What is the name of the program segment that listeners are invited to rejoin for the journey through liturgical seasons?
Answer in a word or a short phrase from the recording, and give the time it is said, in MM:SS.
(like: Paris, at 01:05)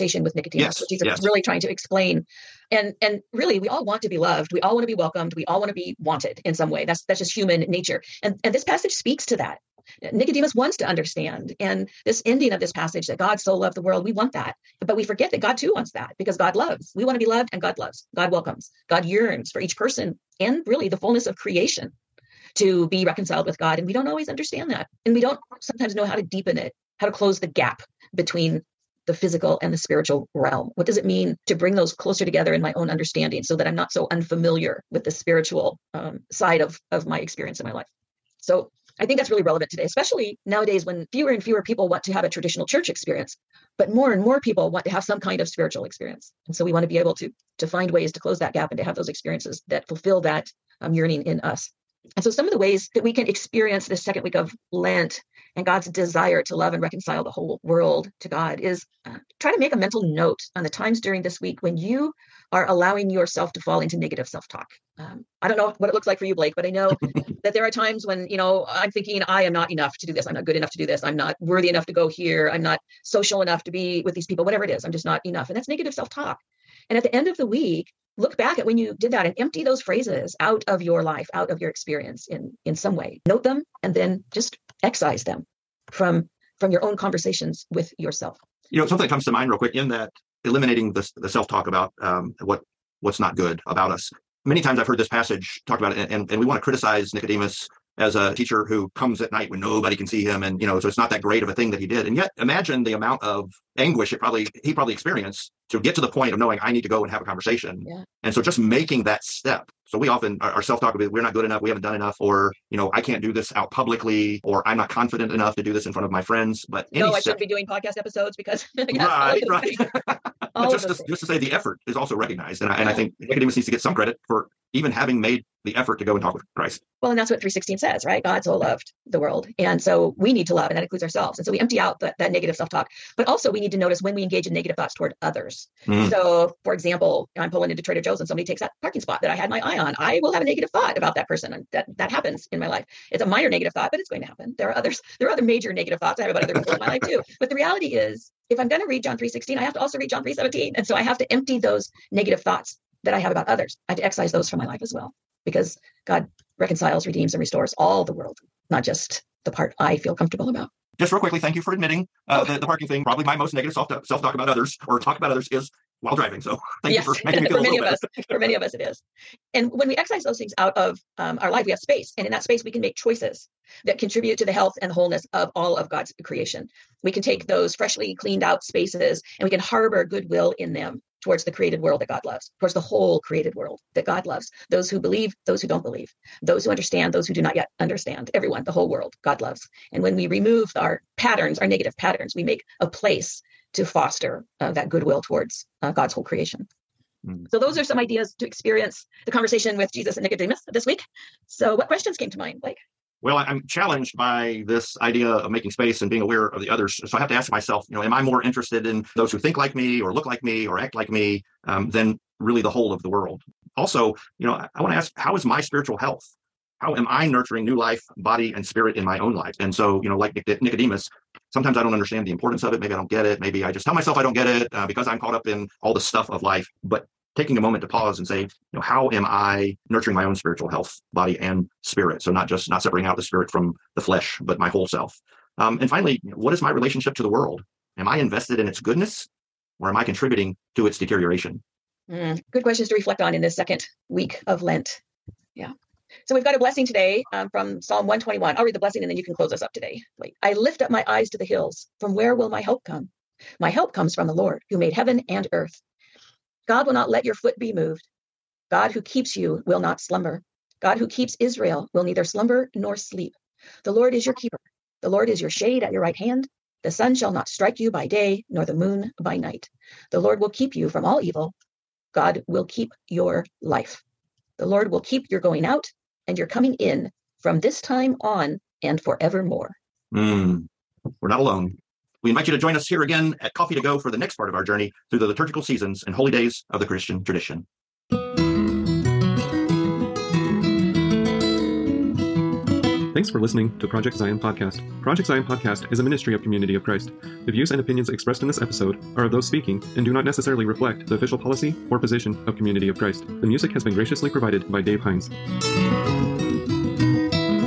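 Coffee to Go, at 04:43.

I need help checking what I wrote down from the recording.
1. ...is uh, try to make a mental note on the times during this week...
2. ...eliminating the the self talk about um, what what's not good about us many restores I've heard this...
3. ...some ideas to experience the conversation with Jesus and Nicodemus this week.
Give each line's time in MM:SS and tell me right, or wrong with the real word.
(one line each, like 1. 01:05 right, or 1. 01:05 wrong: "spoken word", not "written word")
1. 00:58 right
2. 01:30 wrong: "times", not "restores"
3. 03:17 right.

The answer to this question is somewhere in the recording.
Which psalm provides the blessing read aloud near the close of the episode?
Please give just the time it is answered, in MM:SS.
04:07.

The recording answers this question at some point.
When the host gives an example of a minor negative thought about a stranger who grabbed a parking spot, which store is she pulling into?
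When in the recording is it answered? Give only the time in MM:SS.
02:17.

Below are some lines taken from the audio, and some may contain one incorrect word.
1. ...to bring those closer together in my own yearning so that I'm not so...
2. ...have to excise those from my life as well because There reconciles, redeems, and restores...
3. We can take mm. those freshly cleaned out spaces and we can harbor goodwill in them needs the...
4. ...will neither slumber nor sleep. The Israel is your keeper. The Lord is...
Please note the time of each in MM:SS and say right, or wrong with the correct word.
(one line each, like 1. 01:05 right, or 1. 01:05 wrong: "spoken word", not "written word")
1. 00:31 wrong: "understanding", not "yearning"
2. 02:33 wrong: "God", not "There"
3. 02:57 wrong: "towards", not "needs"
4. 04:21 wrong: "Lord", not "Israel".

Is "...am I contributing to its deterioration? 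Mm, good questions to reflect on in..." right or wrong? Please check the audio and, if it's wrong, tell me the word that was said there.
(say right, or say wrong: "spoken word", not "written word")
right.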